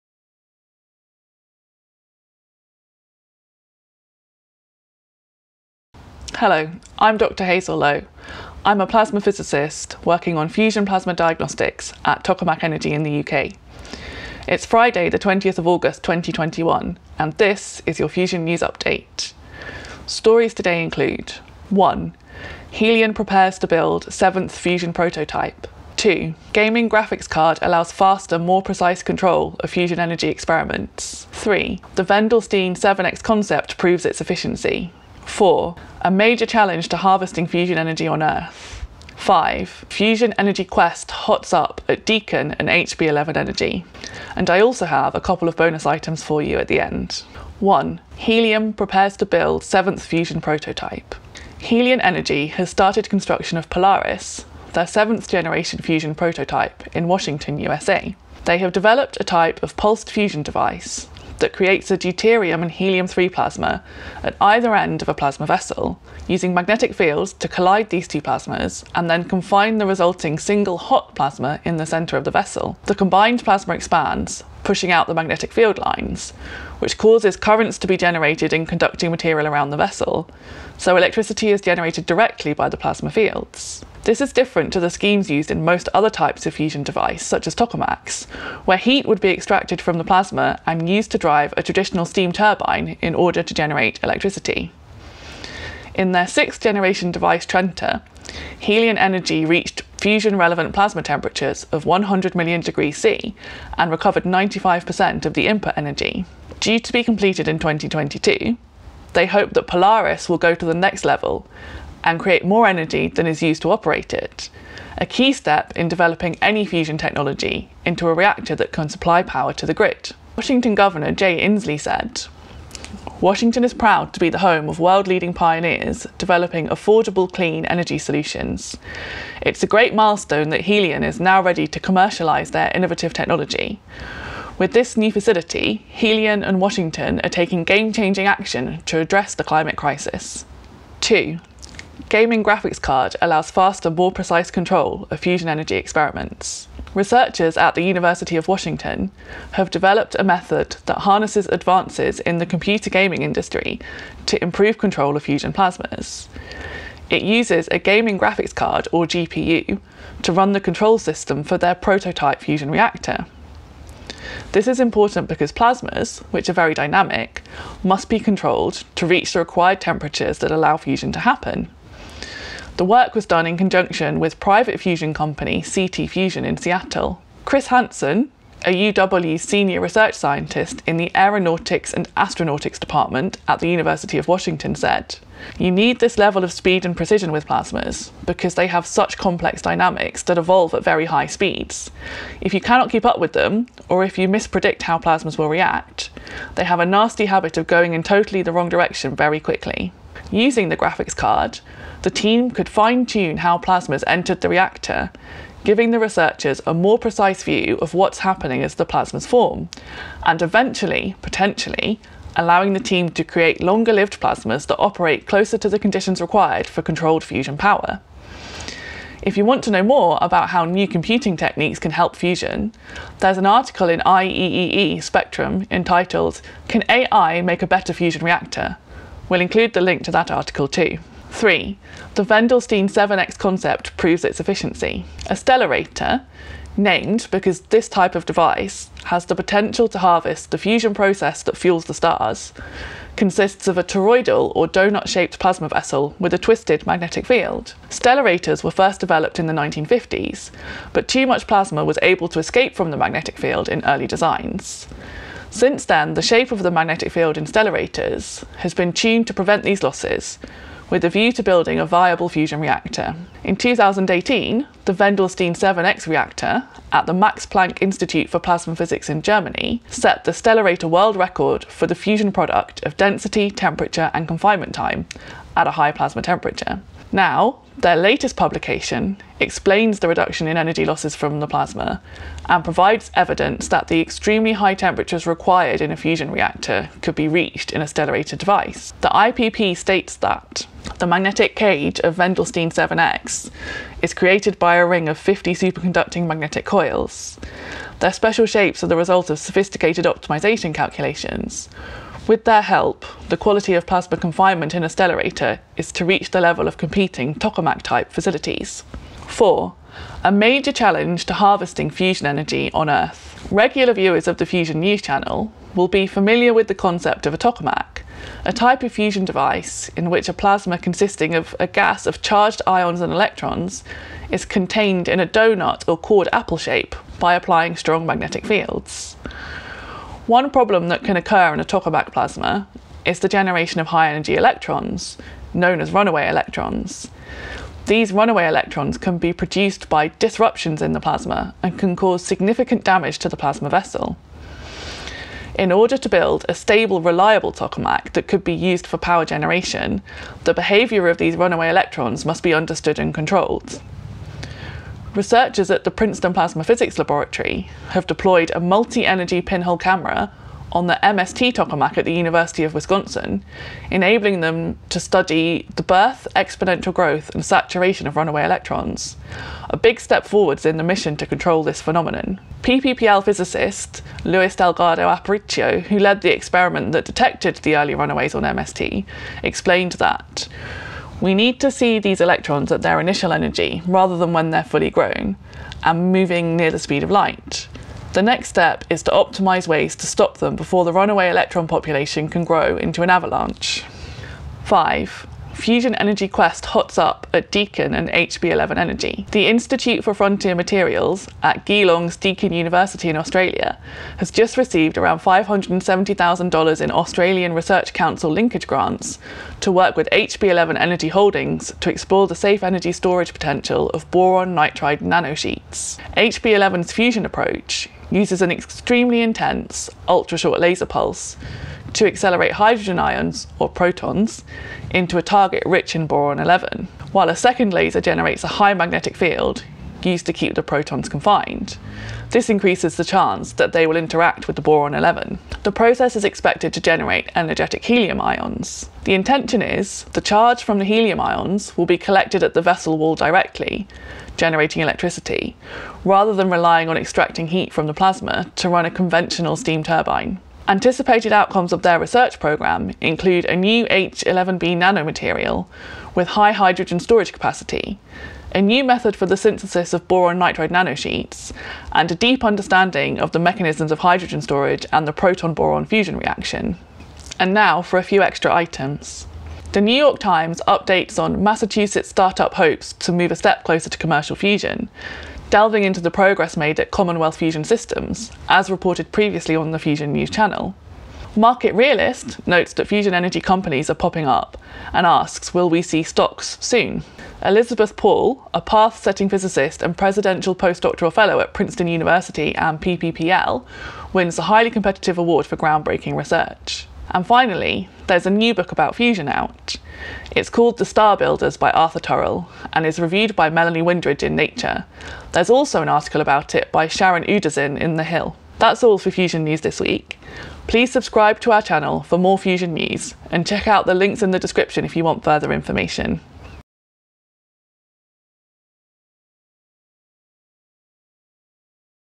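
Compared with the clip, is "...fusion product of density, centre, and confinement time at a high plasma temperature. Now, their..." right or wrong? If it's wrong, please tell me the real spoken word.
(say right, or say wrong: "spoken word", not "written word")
wrong: "temperature", not "centre".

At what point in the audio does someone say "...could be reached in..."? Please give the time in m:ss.
4:47.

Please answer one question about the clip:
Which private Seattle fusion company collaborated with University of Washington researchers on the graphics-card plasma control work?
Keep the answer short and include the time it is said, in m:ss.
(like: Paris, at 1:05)
CT Fusion, at 2:55.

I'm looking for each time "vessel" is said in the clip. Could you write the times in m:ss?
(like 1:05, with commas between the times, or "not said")
1:05, 1:12, 1:19, 4:05, 5:43, 7:22.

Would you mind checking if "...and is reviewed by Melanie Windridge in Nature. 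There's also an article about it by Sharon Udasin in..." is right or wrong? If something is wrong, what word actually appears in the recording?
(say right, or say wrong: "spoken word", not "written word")
right.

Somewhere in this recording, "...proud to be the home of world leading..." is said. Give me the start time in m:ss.
2:03.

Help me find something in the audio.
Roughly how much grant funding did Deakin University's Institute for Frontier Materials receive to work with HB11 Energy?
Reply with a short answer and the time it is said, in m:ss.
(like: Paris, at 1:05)
$570,000, at 6:45.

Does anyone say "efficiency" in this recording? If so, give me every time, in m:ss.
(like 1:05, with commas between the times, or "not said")
0:34, 3:54.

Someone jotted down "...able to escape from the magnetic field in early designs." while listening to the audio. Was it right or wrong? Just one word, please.
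right.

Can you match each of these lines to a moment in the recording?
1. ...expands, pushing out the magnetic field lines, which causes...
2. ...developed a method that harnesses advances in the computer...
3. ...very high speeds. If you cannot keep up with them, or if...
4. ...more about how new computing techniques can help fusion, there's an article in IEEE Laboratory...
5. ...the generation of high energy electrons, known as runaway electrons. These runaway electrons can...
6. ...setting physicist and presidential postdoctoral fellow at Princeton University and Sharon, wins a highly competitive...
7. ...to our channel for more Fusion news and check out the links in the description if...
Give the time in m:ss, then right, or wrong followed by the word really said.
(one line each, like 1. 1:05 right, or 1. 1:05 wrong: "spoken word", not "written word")
1. 1:13 right
2. 2:29 right
3. 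3:10 right
4. 3:39 wrong: "Spectrum", not "Laboratory"
5. 5:33 right
6. 8:09 wrong: "PPPL", not "Sharon"
7. 8:31 right.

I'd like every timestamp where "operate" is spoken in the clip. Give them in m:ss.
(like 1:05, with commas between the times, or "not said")
1:53, 3:34.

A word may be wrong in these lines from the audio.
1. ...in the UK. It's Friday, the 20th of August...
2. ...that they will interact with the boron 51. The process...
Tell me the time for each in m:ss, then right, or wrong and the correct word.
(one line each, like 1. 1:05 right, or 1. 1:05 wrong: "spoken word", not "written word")
1. 0:12 right
2. 7:13 wrong: "11", not "51".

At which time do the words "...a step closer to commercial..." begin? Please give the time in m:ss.
7:53.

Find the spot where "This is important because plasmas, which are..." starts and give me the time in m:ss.
2:44.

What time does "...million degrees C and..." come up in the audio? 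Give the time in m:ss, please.
1:42.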